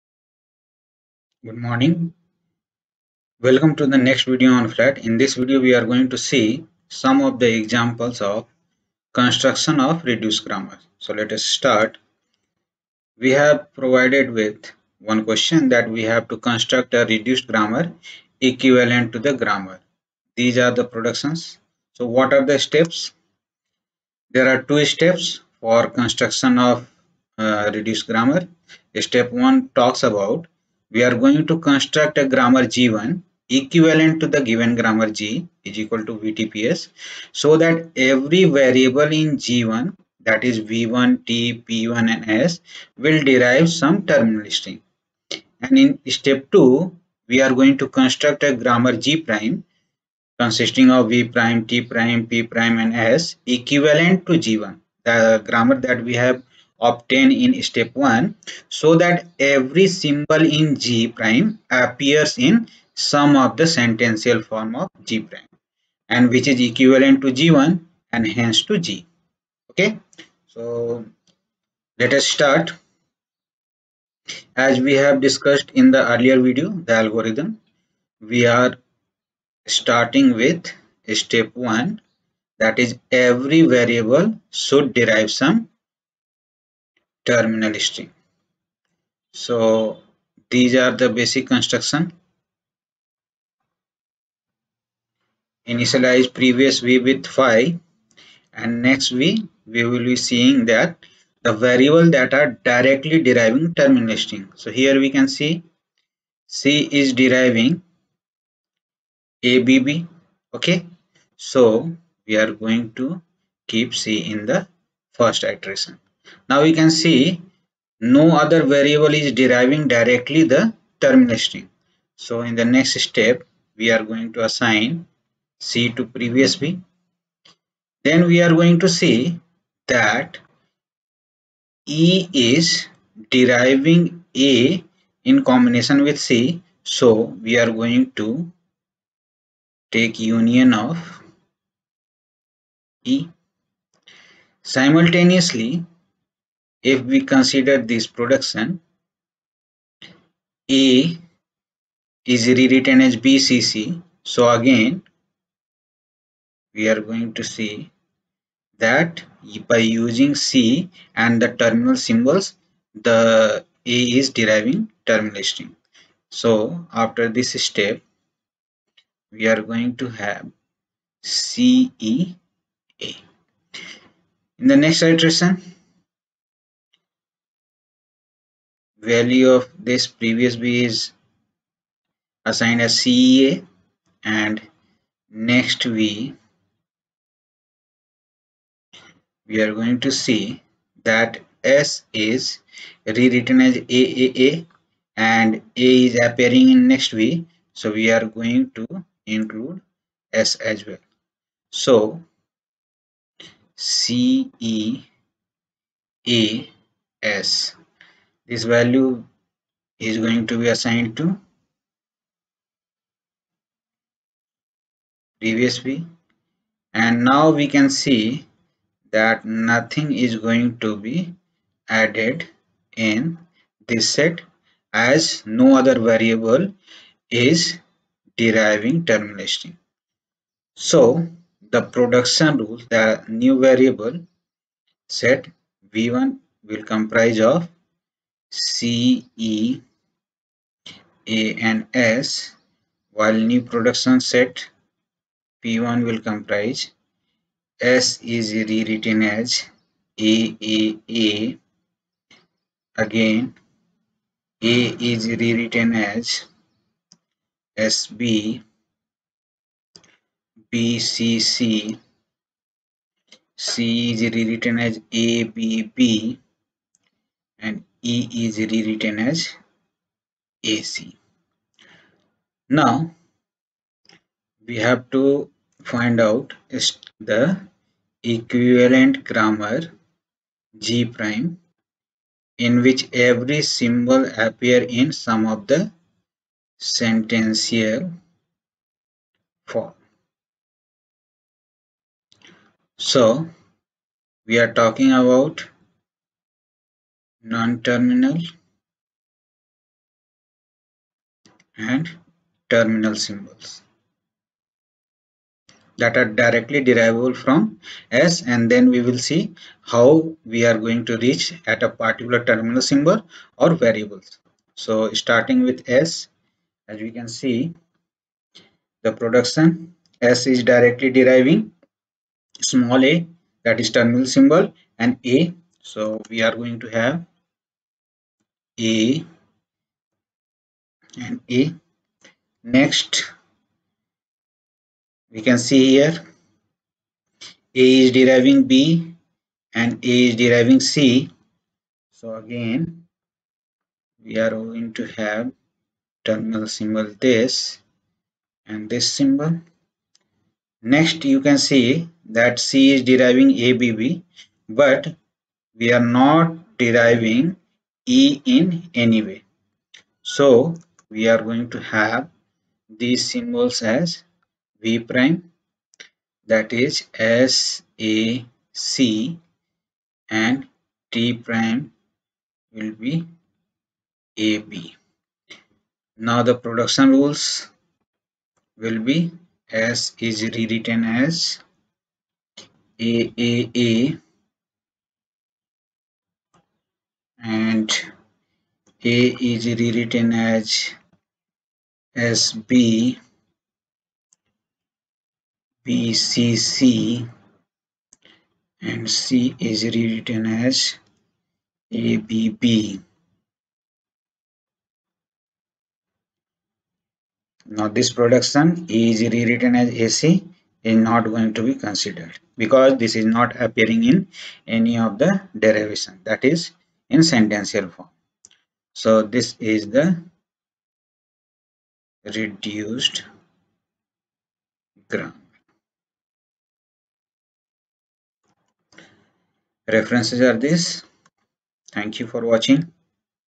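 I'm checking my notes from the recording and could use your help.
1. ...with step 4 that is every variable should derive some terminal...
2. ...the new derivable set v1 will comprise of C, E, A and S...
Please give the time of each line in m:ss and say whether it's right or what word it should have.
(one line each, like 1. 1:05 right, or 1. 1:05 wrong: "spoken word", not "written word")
1. 1:20 wrong: "1", not "4"
2. 3:52 wrong: "variable", not "derivable".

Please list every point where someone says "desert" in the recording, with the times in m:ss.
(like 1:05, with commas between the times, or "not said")
not said.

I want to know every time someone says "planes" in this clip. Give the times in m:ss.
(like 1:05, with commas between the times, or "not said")
not said.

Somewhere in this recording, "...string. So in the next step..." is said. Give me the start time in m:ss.
2:01.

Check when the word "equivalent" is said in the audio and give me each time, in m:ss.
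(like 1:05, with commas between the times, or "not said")
0:18, 0:33, 0:53, 1:06, 4:38.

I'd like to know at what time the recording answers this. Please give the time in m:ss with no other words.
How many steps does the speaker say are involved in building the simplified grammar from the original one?
0:24.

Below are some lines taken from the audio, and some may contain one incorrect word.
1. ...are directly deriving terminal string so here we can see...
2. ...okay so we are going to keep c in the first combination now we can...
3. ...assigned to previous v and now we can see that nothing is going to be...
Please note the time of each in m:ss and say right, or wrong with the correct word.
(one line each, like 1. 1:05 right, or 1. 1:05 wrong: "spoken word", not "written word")
1. 1:42 right
2. 1:50 wrong: "iteration", not "combination"
3. 3:30 right.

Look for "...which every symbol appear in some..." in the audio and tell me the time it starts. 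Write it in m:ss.
4:42.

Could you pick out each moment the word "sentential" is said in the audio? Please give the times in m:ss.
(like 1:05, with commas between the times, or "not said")
1:03, 4:46, 6:57.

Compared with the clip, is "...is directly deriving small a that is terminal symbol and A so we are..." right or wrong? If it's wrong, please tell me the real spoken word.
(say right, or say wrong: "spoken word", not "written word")
right.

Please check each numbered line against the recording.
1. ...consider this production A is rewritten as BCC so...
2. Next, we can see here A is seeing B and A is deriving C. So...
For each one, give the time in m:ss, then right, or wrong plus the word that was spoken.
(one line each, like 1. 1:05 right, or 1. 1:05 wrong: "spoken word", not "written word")
1. 2:27 right
2. 5:32 wrong: "deriving", not "seeing".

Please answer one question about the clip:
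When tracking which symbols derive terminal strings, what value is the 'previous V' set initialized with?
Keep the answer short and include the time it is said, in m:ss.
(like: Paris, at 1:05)
phi, at 1:37.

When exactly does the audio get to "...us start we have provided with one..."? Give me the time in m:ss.
0:11.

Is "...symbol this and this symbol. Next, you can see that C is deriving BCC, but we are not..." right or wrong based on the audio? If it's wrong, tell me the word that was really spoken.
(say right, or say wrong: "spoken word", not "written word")
wrong: "ABB", not "BCC".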